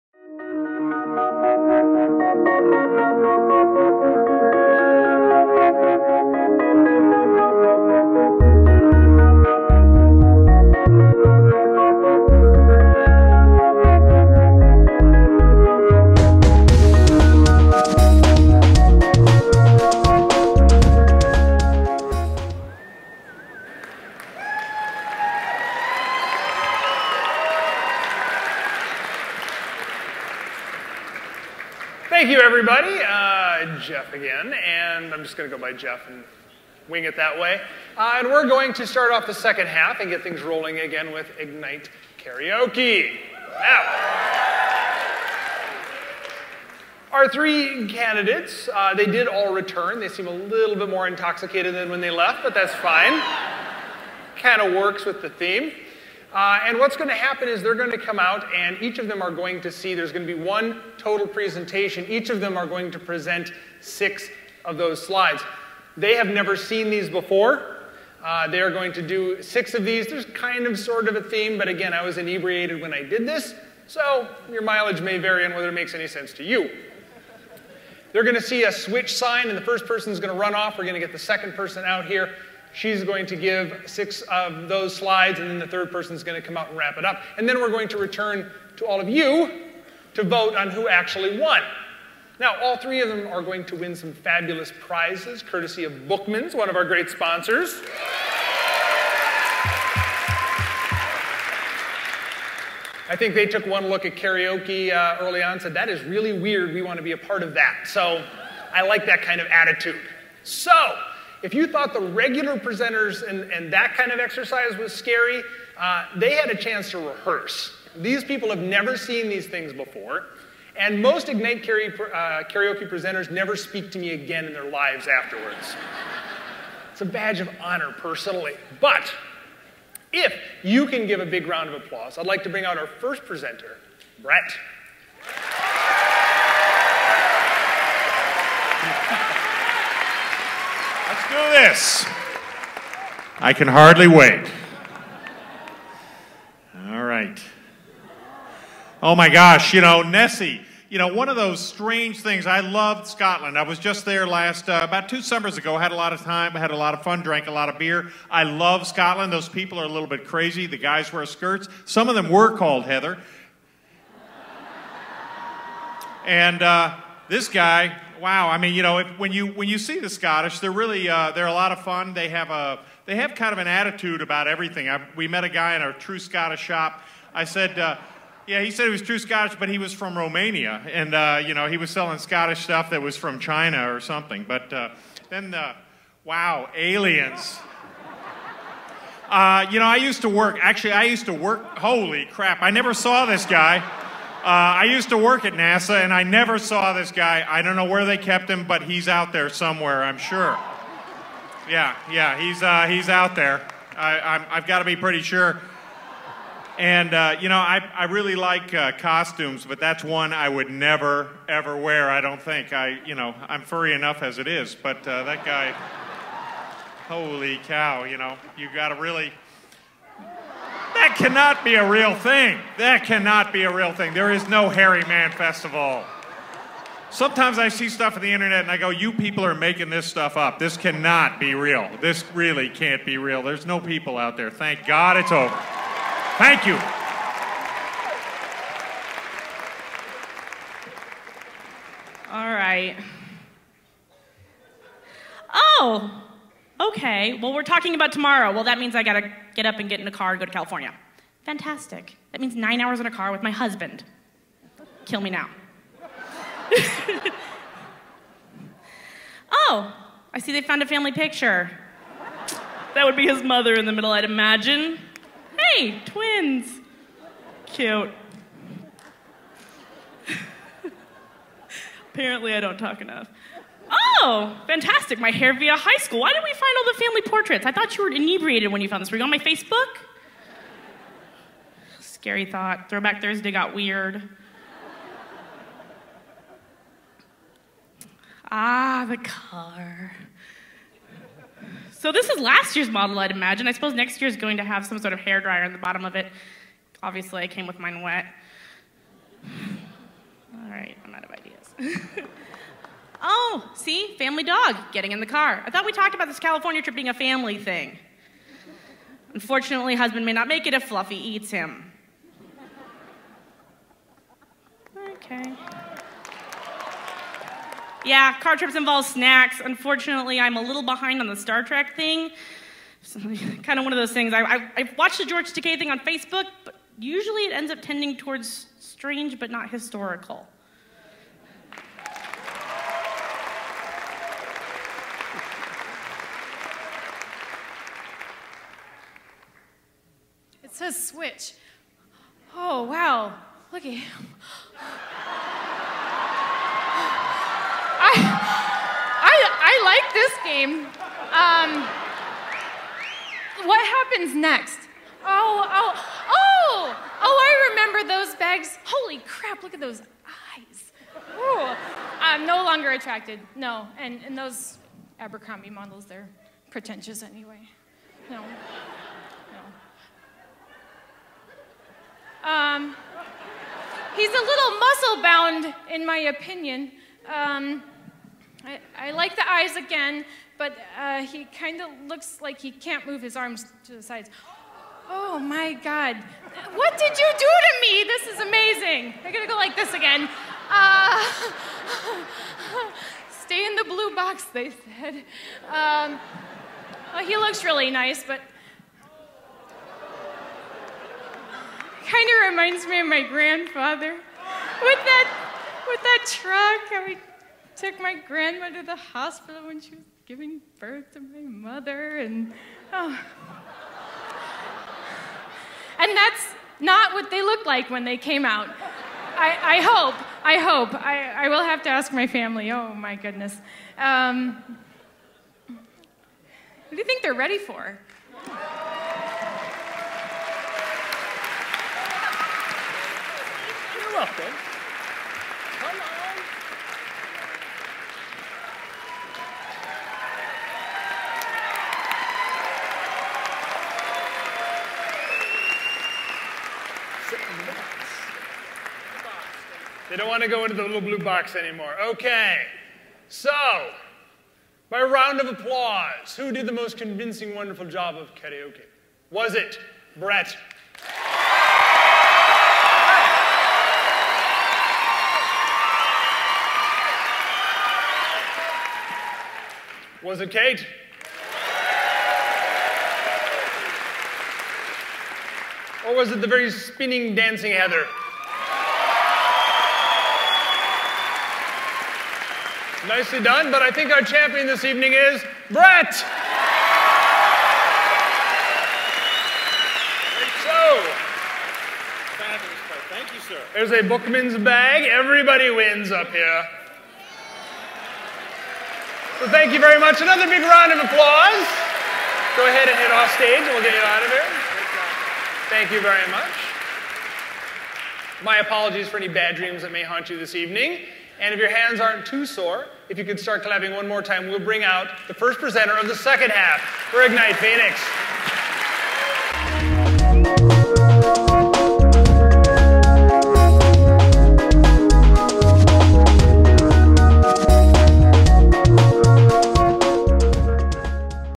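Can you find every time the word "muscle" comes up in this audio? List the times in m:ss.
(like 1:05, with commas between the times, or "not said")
6:14.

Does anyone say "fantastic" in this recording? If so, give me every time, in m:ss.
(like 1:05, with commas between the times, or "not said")
4:11, 4:34.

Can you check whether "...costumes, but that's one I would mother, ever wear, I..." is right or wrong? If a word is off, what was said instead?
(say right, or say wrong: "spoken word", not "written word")
wrong: "never", not "mother".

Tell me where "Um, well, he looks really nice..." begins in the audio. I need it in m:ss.
6:35.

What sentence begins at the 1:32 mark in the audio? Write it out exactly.
Now, all three of them are going to win some fabulous prizes, courtesy of Bookmans, one of our great sponsors.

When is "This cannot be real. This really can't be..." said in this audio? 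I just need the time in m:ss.
3:50.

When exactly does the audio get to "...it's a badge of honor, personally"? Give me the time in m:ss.
2:06.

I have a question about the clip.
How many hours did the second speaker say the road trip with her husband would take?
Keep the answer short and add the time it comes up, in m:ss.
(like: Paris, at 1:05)
9, at 4:12.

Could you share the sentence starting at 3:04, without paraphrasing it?
But uh, then, the wow, aliens!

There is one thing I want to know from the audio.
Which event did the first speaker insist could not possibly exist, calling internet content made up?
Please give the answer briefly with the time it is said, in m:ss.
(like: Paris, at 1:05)
Hairy Man Festival, at 3:44.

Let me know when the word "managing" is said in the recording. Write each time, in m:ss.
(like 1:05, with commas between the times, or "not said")
not said.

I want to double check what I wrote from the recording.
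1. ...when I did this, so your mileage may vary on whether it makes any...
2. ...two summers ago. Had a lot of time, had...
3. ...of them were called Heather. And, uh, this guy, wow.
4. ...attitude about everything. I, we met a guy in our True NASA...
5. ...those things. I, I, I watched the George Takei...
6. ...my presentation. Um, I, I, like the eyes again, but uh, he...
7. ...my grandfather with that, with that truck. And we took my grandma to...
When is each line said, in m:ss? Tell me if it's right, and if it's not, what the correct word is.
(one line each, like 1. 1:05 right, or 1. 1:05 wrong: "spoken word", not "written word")
1. 1:12 right
2. 2:35 right
3. 2:42 right
4. 2:53 wrong: "Scottish", not "NASA"
5. 5:23 right
6. 6:16 wrong: "opinion", not "presentation"
7. 6:43 right.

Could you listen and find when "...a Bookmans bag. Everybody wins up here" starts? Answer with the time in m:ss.
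8:13.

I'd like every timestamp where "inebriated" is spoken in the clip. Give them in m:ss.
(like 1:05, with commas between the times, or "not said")
1:12, 4:38.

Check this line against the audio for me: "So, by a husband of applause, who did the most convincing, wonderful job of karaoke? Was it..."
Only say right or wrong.
wrong.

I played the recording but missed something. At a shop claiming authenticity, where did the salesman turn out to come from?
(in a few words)
Romania.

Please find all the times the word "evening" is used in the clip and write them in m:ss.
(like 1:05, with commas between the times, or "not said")
8:04, 8:30.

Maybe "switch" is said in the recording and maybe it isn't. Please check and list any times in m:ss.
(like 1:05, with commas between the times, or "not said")
1:18, 5:40.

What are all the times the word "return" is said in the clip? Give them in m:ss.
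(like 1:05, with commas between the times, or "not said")
0:49, 1:27.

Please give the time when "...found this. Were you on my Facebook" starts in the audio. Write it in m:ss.
4:38.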